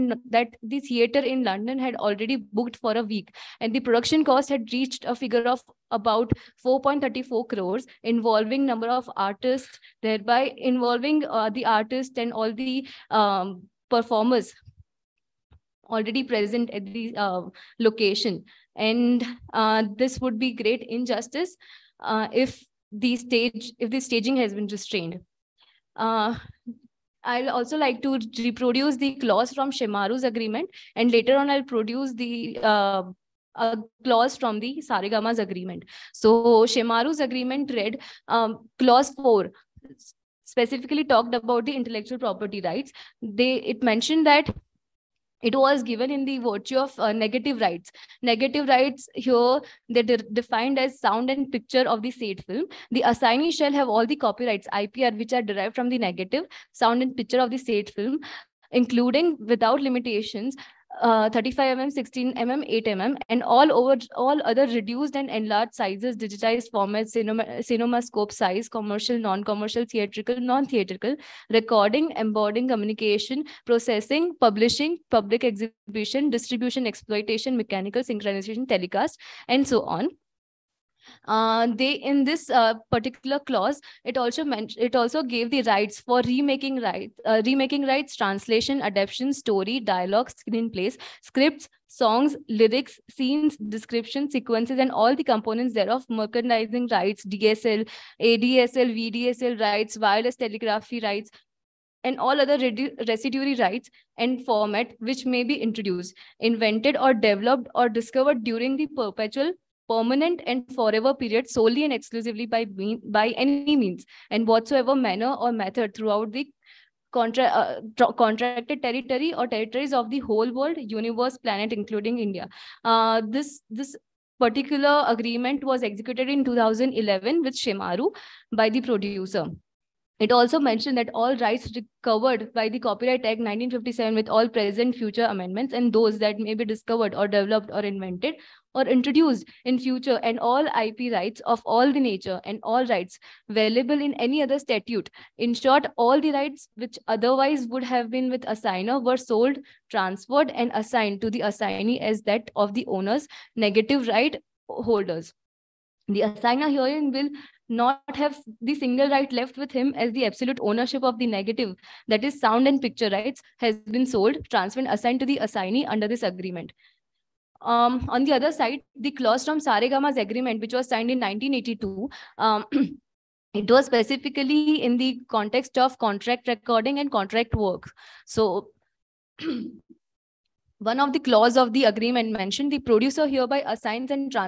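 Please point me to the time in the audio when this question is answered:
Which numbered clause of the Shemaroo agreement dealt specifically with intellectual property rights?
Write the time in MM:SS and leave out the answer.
00:38.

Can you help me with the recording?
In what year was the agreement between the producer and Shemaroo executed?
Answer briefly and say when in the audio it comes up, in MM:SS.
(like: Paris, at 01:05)
2011, at 02:06.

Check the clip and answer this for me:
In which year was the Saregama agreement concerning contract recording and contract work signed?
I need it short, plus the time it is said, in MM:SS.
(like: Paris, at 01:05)
1982, at 02:51.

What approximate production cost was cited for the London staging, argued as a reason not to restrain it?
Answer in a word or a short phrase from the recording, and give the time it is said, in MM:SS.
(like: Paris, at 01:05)
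4.34 crores, at 00:06.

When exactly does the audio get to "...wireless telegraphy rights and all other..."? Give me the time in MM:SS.
01:39.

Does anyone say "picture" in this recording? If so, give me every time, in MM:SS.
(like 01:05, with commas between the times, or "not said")
00:51, 00:57, 02:42.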